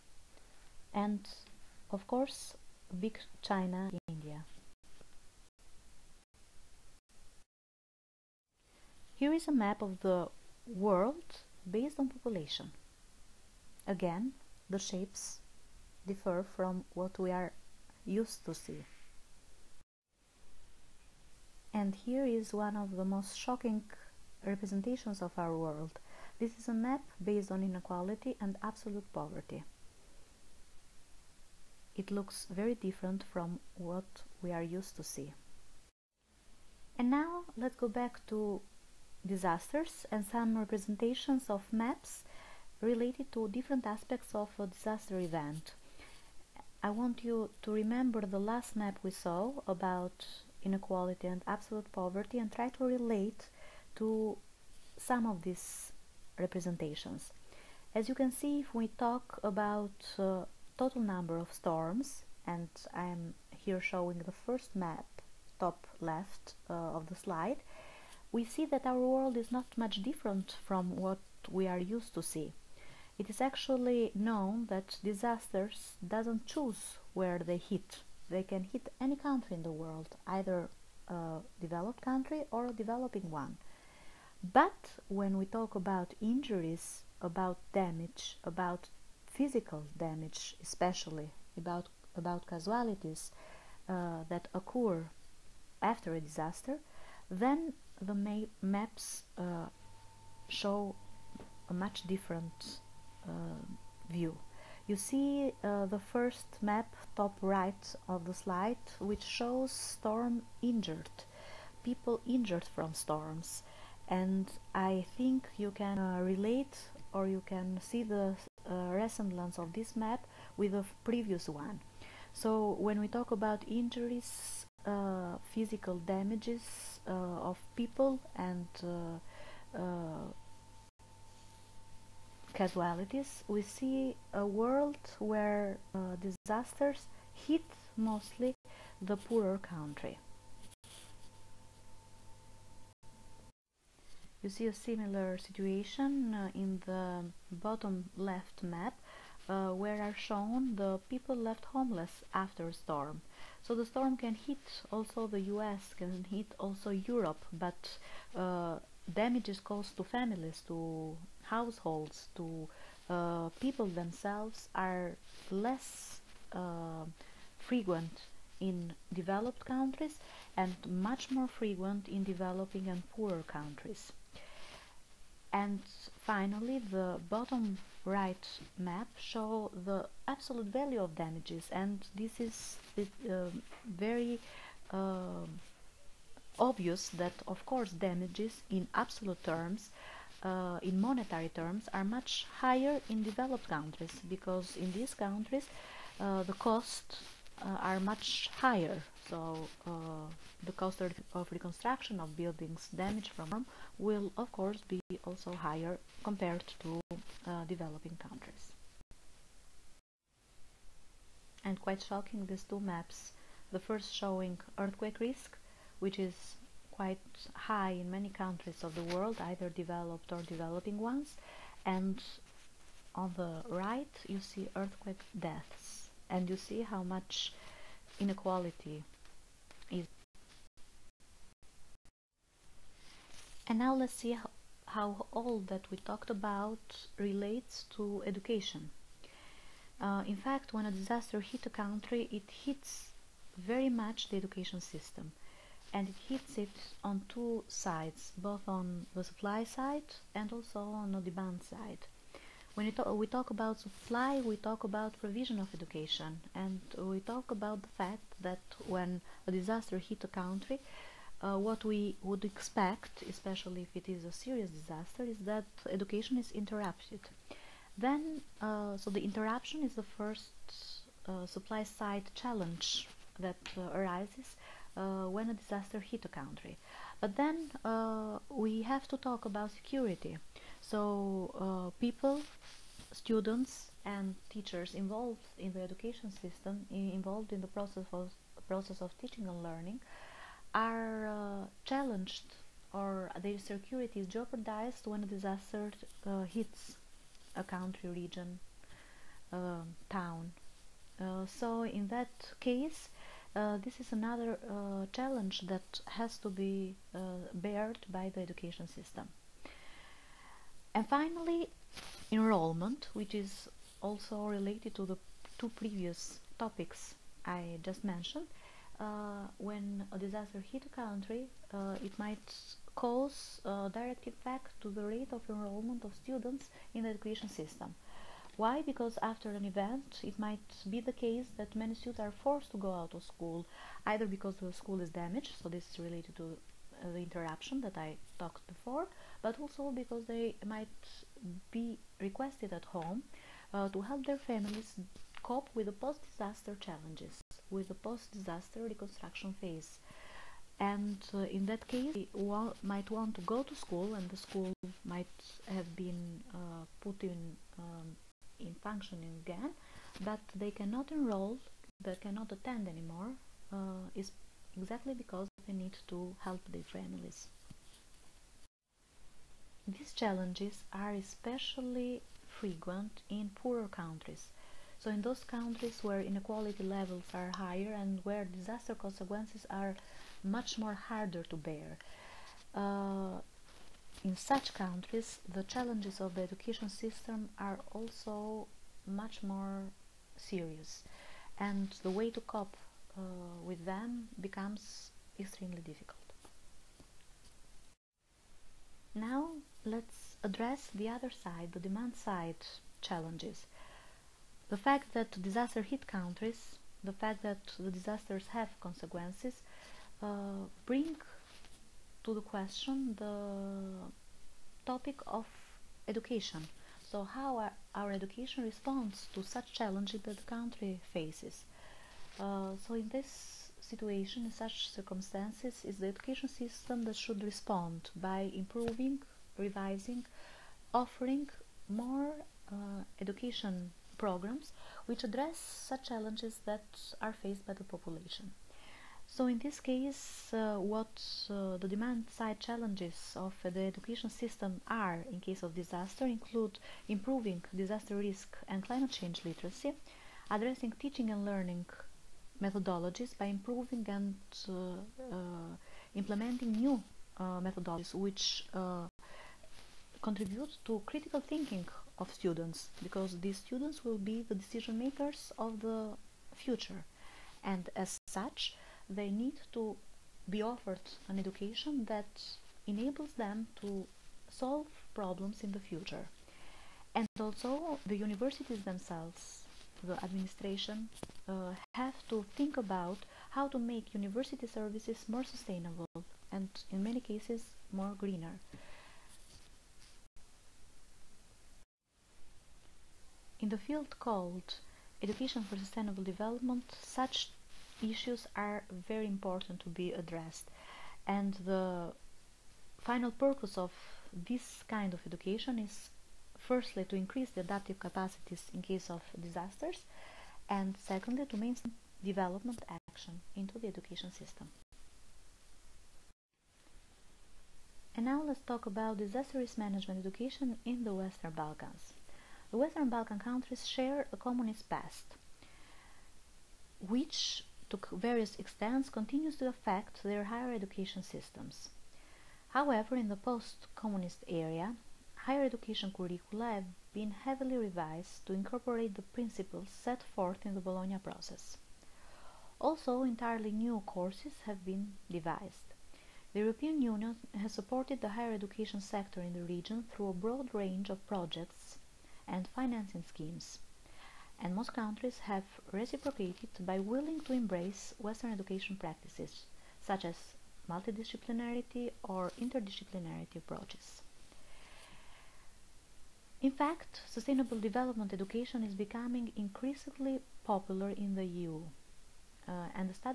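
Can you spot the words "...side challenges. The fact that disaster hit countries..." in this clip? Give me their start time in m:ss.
6:42.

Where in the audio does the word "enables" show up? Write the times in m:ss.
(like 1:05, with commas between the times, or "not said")
7:52.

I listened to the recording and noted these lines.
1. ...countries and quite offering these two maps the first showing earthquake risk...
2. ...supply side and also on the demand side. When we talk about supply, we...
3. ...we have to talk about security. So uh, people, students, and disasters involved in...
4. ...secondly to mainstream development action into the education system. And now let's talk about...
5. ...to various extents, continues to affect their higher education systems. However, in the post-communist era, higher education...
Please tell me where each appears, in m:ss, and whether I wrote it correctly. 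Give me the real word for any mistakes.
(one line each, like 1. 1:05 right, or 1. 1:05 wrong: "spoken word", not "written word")
1. 3:28 wrong: "shocking", not "offering"
2. 4:09 right
3. 4:38 wrong: "teachers", not "disasters"
4. 8:31 right
5. 8:47 right.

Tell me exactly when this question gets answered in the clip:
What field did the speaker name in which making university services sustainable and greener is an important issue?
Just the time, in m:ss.
8:15.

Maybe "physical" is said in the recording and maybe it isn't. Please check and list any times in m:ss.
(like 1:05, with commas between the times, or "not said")
1:29, 2:05.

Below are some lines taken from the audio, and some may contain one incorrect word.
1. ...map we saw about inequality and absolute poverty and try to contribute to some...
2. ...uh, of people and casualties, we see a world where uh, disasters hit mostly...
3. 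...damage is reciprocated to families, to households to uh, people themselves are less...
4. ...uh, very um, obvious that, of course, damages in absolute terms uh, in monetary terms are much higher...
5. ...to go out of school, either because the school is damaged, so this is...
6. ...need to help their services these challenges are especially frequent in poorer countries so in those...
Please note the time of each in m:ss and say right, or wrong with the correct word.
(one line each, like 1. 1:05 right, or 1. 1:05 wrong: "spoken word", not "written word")
1. 0:48 wrong: "relate", not "contribute"
2. 2:07 right
3. 2:39 wrong: "caused", not "reciprocated"
4. 3:02 right
5. 5:32 right
6. 6:05 wrong: "families", not "services".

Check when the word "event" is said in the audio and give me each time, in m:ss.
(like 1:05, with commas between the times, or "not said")
0:45, 5:29.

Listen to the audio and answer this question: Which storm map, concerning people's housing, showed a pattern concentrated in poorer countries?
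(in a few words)
people left homeless.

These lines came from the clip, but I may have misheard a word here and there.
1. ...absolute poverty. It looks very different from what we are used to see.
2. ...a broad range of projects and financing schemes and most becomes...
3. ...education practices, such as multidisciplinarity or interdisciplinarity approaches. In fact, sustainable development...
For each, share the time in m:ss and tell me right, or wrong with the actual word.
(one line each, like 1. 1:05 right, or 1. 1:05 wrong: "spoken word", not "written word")
1. 0:28 right
2. 9:10 wrong: "countries", not "becomes"
3. 9:18 right.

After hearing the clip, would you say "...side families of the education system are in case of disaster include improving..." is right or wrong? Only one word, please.
wrong.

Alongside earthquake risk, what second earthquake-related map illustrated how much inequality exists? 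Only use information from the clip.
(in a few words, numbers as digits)
earthquake deaths.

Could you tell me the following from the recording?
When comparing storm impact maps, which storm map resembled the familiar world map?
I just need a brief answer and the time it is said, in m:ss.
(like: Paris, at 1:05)
total number of storms, at 1:00.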